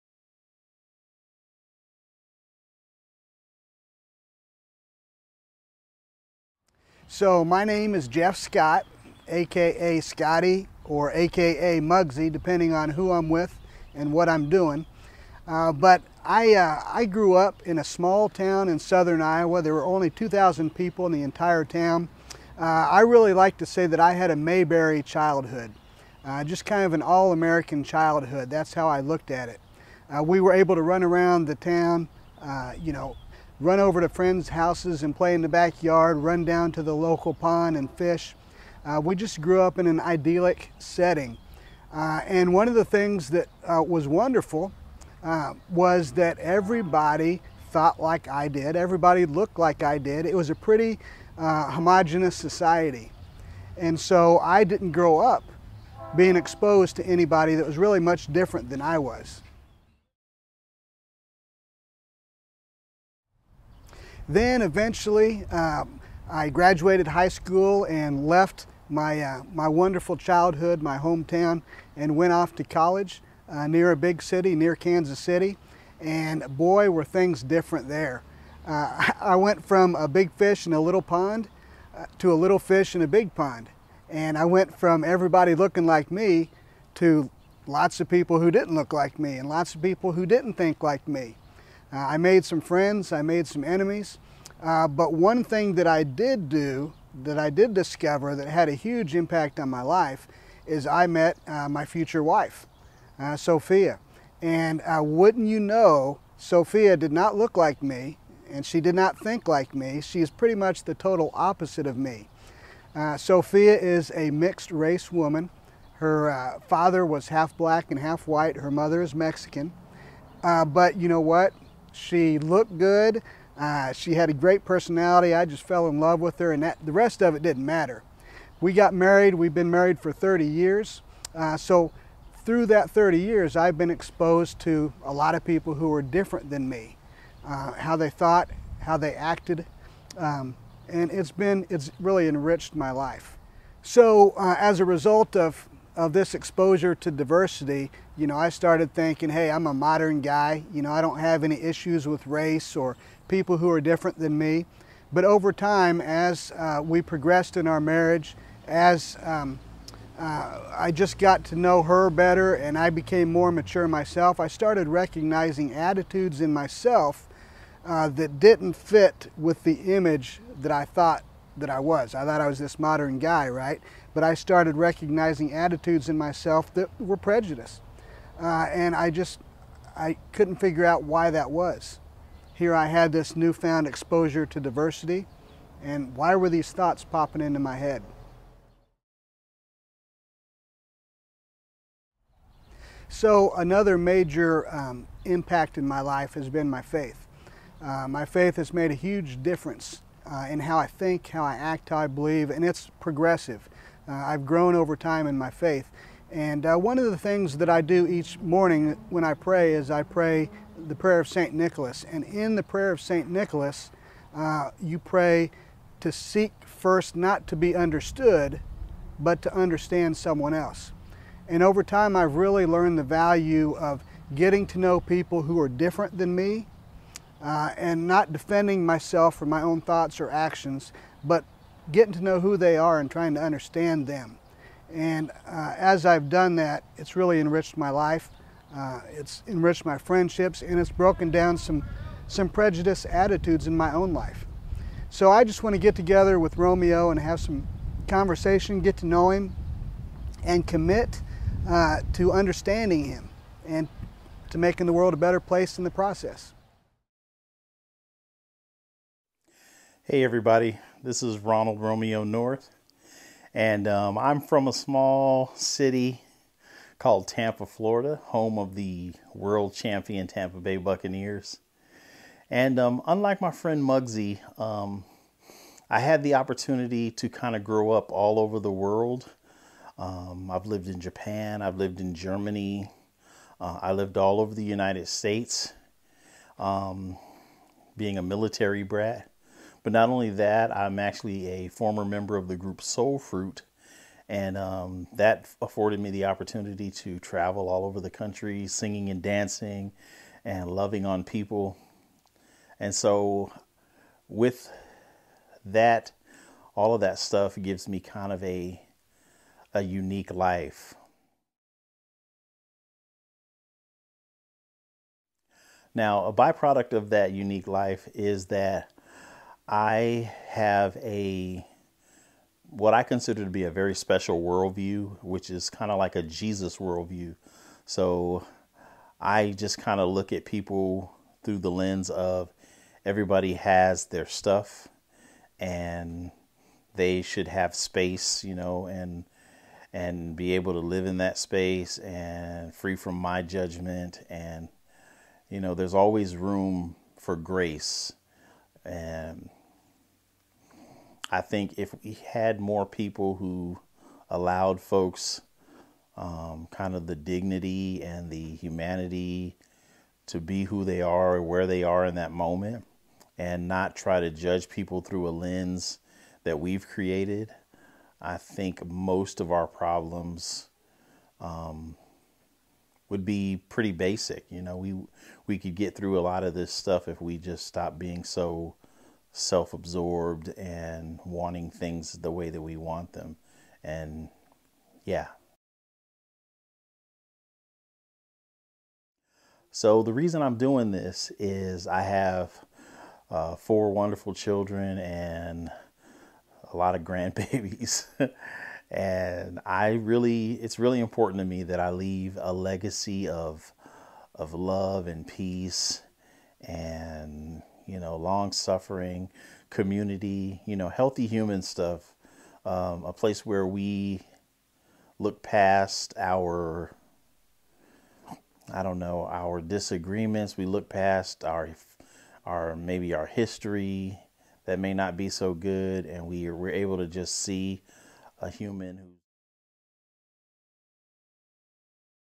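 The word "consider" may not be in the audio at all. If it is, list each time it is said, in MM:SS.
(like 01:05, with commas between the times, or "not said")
05:23.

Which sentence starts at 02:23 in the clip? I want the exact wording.
So uh, as a result of of this exposure to diversity, you know, I started thinking, hey, I'm a modern guy.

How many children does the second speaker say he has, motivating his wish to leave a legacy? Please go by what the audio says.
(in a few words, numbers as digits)
4.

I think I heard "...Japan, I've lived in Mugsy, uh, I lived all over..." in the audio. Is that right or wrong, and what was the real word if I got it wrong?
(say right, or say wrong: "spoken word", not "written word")
wrong: "Germany", not "Mugsy".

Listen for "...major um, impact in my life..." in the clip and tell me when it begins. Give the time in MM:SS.
03:13.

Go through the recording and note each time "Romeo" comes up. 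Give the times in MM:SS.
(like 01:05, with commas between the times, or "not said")
04:06, 04:21.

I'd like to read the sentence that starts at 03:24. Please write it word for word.
Uh, I've grown over time in my faith.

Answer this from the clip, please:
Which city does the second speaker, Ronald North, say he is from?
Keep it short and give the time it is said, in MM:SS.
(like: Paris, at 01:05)
Tampa, Florida, at 04:27.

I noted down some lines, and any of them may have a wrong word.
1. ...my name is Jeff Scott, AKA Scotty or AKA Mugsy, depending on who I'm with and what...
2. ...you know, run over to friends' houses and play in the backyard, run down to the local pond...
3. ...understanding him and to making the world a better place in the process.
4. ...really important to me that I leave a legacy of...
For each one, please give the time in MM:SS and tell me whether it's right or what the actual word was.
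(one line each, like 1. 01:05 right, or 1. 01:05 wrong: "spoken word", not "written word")
1. 00:07 right
2. 00:32 right
3. 04:12 right
4. 06:40 right.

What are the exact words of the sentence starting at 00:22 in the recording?
Uh, I really like to say that I had a Mayberry childhood, uh, just kind of an all-American childhood.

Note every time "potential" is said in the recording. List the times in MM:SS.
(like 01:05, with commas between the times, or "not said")
not said.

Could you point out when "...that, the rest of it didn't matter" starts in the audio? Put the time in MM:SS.
02:06.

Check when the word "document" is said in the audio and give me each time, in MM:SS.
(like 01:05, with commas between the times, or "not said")
not said.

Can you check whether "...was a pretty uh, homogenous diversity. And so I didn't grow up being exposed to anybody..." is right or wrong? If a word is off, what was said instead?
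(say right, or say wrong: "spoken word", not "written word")
wrong: "society", not "diversity".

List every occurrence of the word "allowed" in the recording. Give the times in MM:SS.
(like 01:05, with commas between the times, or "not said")
05:54.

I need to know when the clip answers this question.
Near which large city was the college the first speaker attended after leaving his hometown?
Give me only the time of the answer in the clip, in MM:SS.
01:14.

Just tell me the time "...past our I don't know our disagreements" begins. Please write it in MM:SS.
06:55.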